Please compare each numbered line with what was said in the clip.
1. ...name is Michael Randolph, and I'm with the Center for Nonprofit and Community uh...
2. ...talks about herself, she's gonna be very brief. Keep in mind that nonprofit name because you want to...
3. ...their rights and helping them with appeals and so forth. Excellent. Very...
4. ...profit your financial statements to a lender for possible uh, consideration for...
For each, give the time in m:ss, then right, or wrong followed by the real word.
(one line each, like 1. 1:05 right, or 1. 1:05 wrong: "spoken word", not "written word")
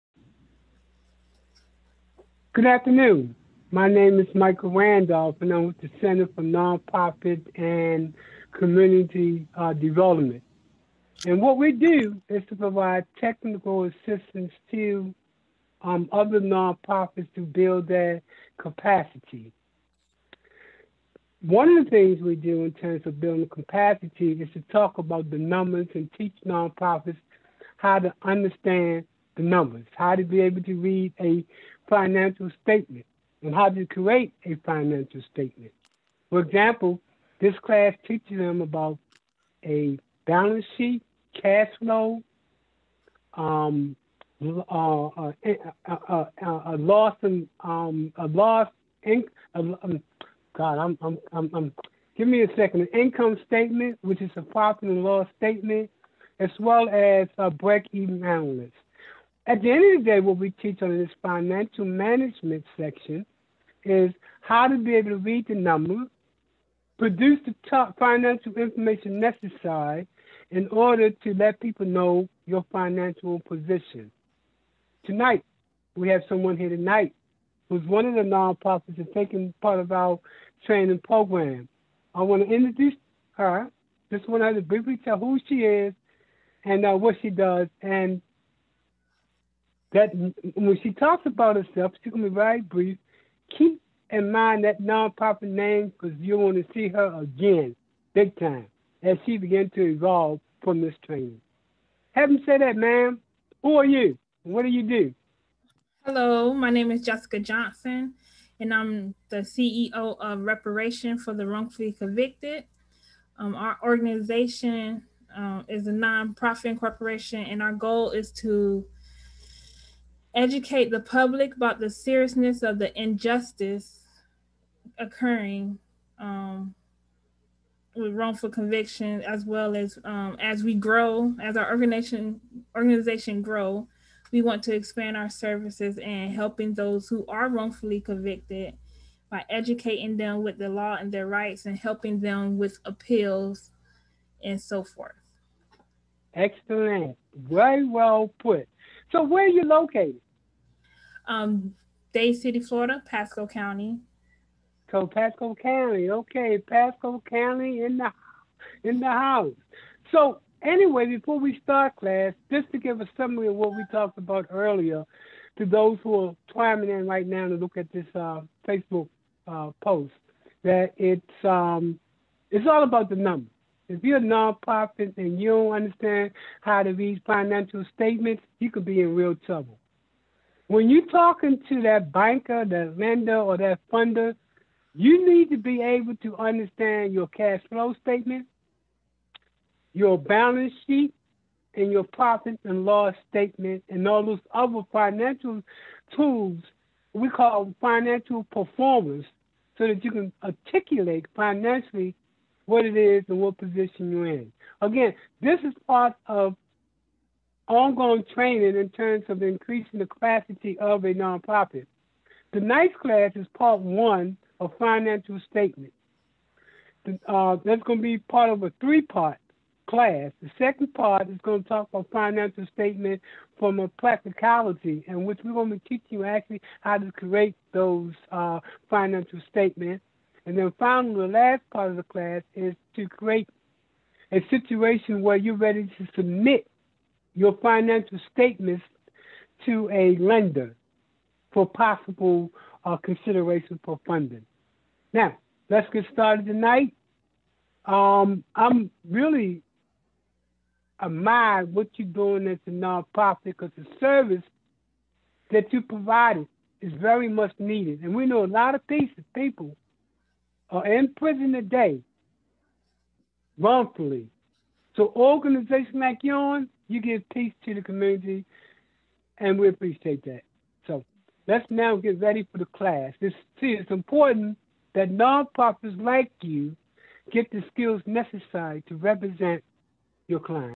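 1. 0:03 right
2. 1:30 right
3. 2:21 right
4. 3:56 wrong: "submit", not "profit".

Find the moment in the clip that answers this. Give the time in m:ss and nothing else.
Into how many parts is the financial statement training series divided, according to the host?
3:38.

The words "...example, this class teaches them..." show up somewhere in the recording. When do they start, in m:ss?
0:36.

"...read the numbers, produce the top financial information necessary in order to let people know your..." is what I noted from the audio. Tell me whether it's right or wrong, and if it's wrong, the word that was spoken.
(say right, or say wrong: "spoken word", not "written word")
right.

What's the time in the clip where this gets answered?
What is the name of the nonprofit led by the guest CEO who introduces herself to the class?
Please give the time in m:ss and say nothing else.
1:50.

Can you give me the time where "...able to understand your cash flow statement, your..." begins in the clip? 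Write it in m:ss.
3:05.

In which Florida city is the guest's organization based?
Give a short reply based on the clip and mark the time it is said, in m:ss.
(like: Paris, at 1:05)
Dade City, at 2:32.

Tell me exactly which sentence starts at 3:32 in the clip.
Tonight's class is part one of financial statement.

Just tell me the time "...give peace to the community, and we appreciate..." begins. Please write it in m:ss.
4:27.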